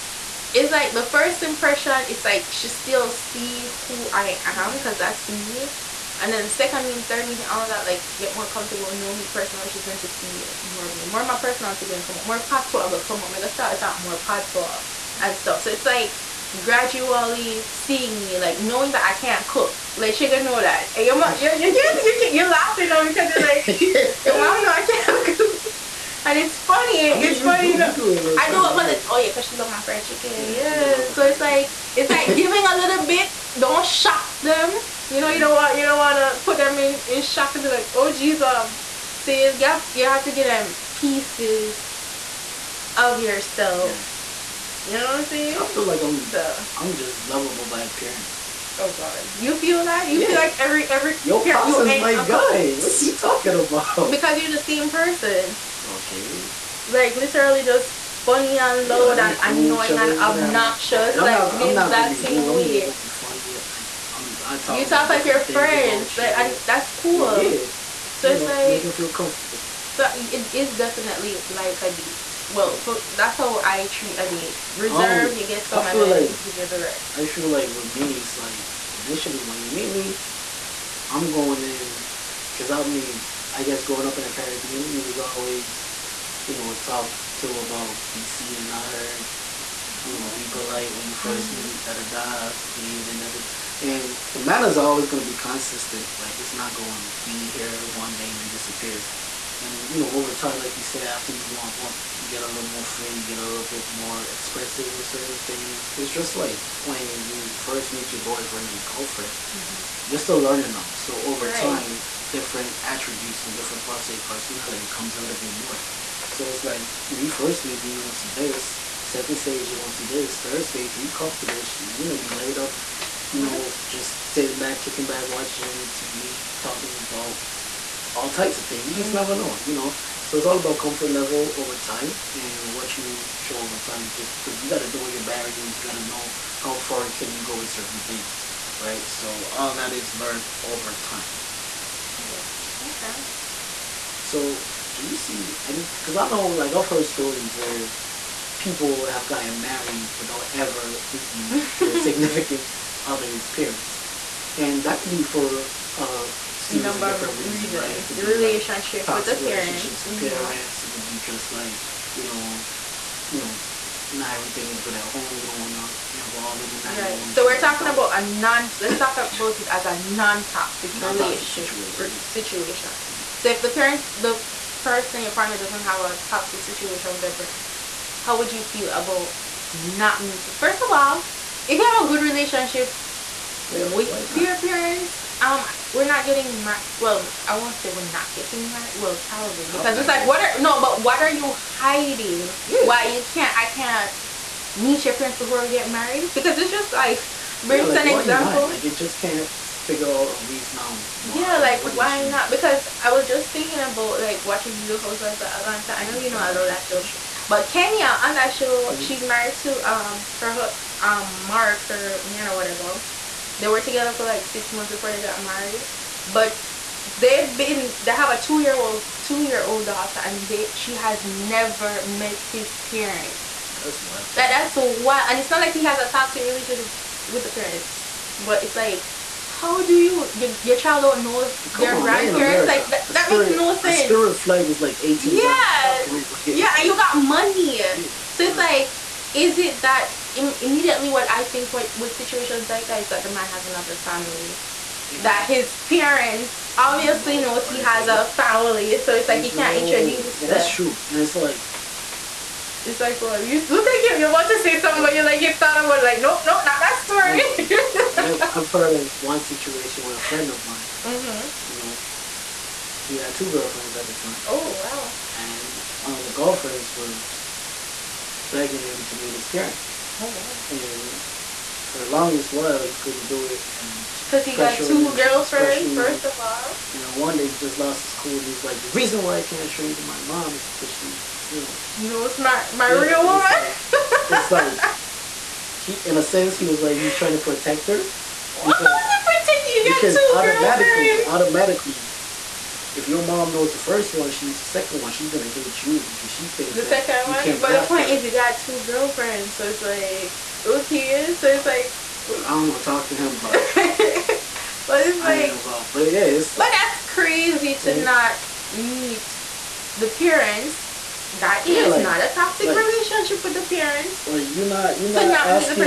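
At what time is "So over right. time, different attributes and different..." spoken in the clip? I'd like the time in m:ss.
1:50.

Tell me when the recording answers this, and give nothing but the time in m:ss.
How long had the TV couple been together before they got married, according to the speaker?
3:34.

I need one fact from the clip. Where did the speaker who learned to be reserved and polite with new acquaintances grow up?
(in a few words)
The Caribbean.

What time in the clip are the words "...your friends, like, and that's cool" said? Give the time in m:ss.
1:05.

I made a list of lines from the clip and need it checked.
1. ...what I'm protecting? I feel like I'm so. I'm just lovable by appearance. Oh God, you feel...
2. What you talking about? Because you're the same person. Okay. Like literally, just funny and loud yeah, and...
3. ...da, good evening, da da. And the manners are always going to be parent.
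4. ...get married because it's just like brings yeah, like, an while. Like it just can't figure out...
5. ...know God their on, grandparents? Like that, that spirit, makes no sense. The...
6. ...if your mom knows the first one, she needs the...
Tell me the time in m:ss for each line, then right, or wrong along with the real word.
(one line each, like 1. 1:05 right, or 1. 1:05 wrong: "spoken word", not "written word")
1. 0:45 wrong: "saying", not "protecting"
2. 0:52 right
3. 1:32 wrong: "consistent", not "parent"
4. 3:15 wrong: "example", not "while"
5. 3:51 wrong: "Come", not "God"
6. 4:52 right.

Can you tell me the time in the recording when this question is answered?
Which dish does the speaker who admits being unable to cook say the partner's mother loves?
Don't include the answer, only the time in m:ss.
0:29.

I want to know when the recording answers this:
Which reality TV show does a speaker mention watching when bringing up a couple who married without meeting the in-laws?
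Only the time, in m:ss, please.
3:24.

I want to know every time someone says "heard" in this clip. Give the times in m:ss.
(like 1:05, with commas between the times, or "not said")
1:28, 2:26, 4:18.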